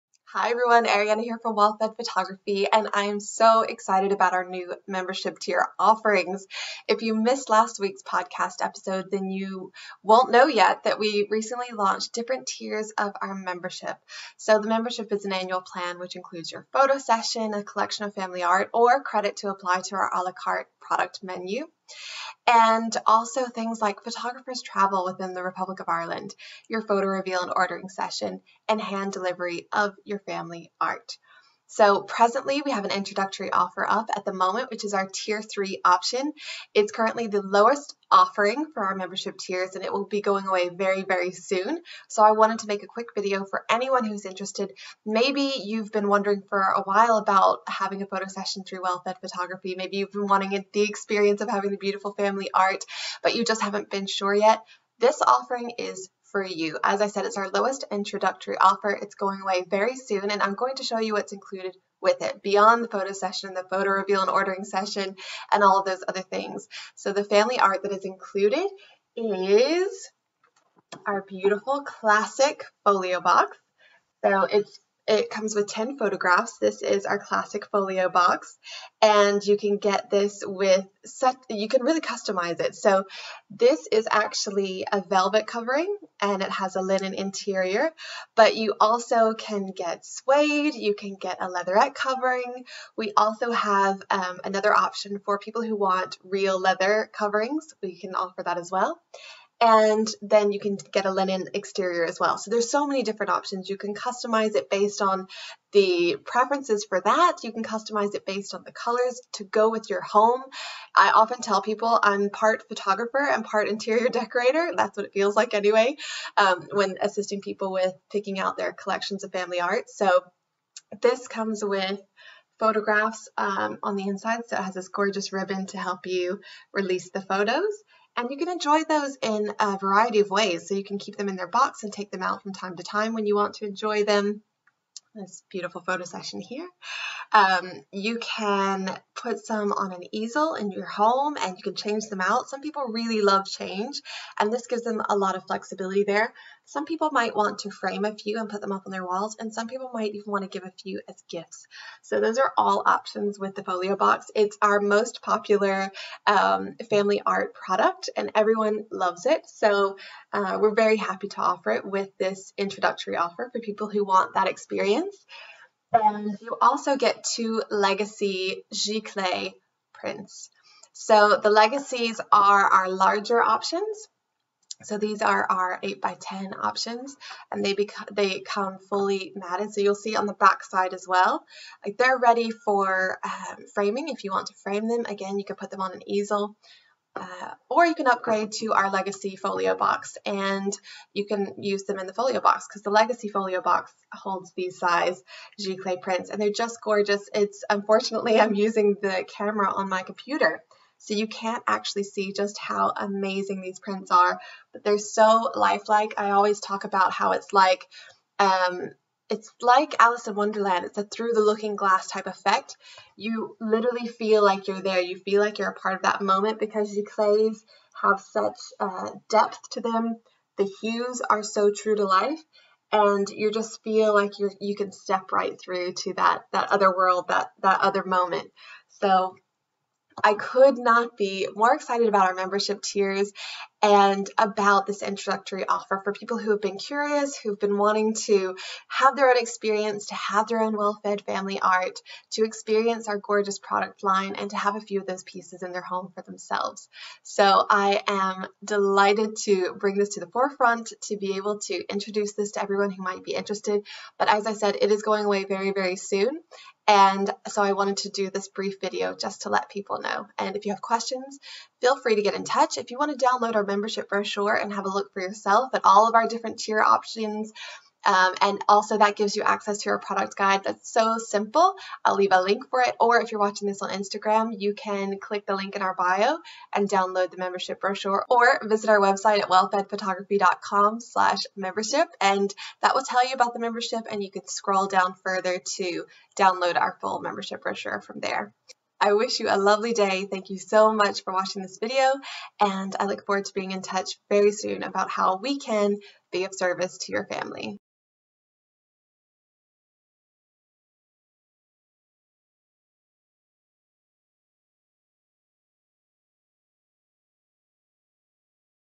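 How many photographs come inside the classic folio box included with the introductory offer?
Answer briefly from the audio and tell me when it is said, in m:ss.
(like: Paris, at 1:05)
10, at 1:15.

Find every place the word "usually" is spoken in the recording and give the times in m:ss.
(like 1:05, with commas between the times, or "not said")
not said.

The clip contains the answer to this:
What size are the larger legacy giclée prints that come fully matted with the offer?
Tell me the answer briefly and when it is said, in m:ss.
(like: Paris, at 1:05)
8 by 10, at 2:55.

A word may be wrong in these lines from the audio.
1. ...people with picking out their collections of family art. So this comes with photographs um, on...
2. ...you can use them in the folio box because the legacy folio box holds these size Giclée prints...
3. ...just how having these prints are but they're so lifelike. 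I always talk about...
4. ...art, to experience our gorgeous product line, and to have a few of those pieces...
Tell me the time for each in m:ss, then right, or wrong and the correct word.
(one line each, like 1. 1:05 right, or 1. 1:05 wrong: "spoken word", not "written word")
1. 1:57 right
2. 3:11 right
3. 3:22 wrong: "amazing", not "having"
4. 4:01 right.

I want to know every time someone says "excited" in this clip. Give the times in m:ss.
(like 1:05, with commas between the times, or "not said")
0:03, 3:51.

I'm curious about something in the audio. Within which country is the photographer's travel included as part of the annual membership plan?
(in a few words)
Republic of Ireland.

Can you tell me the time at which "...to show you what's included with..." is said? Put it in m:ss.
1:00.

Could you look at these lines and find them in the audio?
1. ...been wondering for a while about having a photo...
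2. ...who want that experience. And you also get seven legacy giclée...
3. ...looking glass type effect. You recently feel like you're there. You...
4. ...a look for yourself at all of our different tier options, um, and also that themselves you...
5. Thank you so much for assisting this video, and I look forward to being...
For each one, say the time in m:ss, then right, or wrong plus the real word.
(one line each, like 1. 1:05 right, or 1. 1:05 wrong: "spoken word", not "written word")
1. 0:45 right
2. 2:43 wrong: "two", not "seven"
3. 3:31 wrong: "literally", not "recently"
4. 4:24 wrong: "gives", not "themselves"
5. 4:50 wrong: "watching", not "assisting".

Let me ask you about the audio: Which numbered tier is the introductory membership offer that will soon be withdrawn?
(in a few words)
Tier three.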